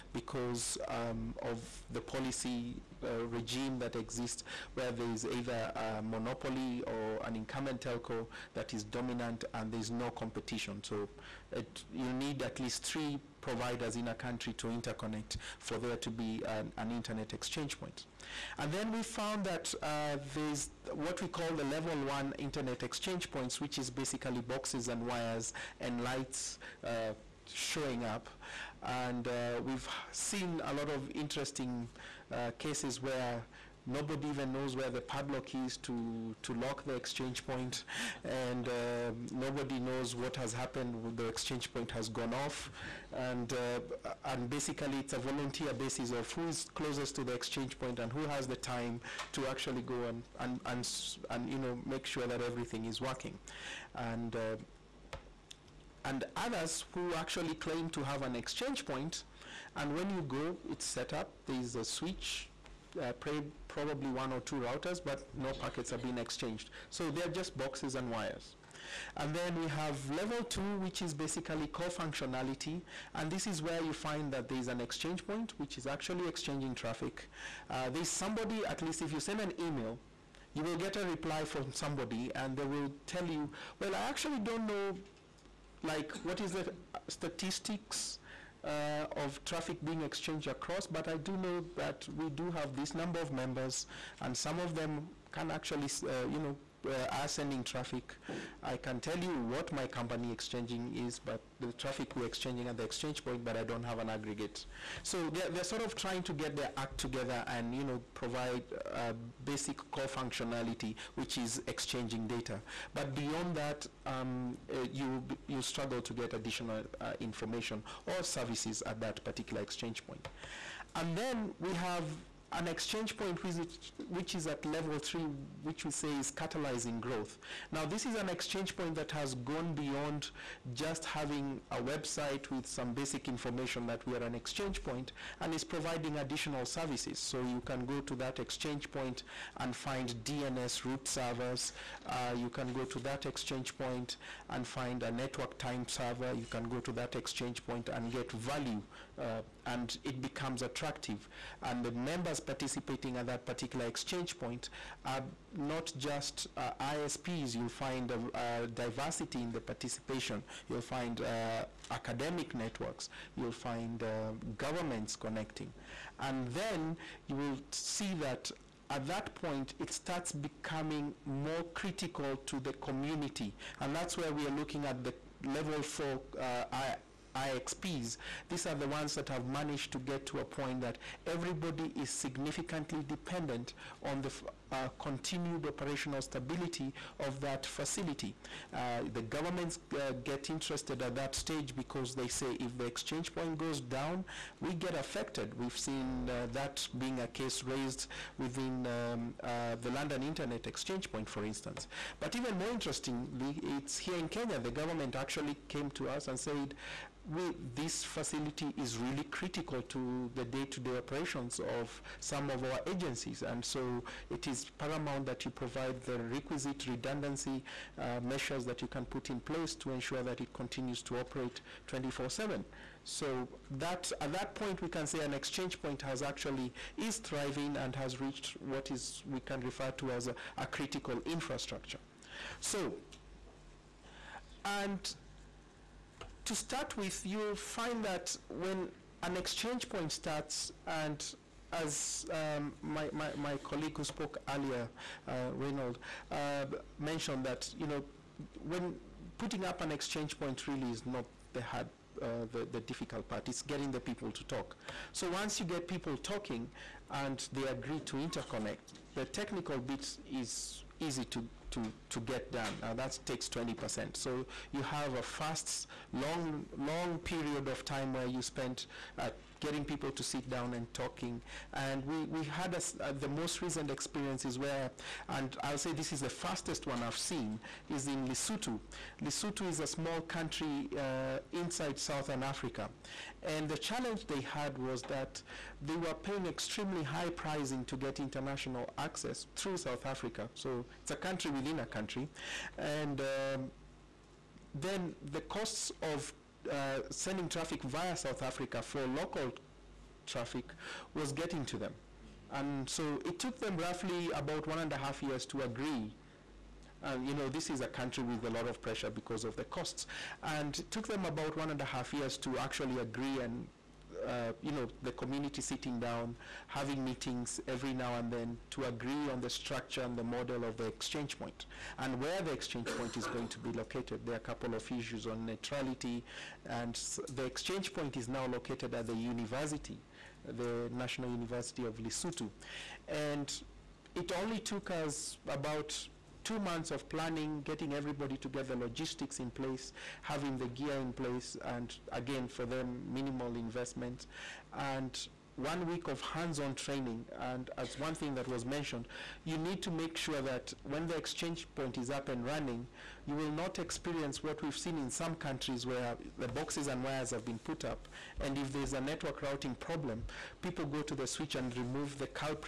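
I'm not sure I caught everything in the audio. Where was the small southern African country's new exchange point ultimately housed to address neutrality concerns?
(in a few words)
National University of Lesotho.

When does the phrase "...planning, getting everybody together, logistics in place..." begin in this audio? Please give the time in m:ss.
5:37.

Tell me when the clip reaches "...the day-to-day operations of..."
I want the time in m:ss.
3:30.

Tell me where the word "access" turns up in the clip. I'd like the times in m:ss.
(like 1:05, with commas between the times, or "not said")
4:48.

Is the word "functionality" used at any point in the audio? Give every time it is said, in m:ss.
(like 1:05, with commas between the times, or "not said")
1:11, 1:50.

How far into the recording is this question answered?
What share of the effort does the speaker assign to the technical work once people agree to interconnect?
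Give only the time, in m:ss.
4:23.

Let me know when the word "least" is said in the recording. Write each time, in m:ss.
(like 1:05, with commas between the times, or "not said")
0:12, 1:18.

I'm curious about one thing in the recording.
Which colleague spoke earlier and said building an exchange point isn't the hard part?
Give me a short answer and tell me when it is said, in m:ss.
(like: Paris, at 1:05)
Reynold, at 4:05.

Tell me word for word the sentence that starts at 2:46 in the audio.
And then you will see that at that point, it starts becoming more critical to the community.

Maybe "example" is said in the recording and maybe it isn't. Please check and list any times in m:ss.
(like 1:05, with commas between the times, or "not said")
not said.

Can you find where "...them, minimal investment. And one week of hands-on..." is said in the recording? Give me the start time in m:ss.
5:42.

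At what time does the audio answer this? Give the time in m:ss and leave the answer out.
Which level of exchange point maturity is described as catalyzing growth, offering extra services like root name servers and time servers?
2:04.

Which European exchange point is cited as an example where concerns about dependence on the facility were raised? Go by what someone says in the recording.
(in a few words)
London Internet Exchange Point.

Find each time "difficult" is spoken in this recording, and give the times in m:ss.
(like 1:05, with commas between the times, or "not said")
4:12.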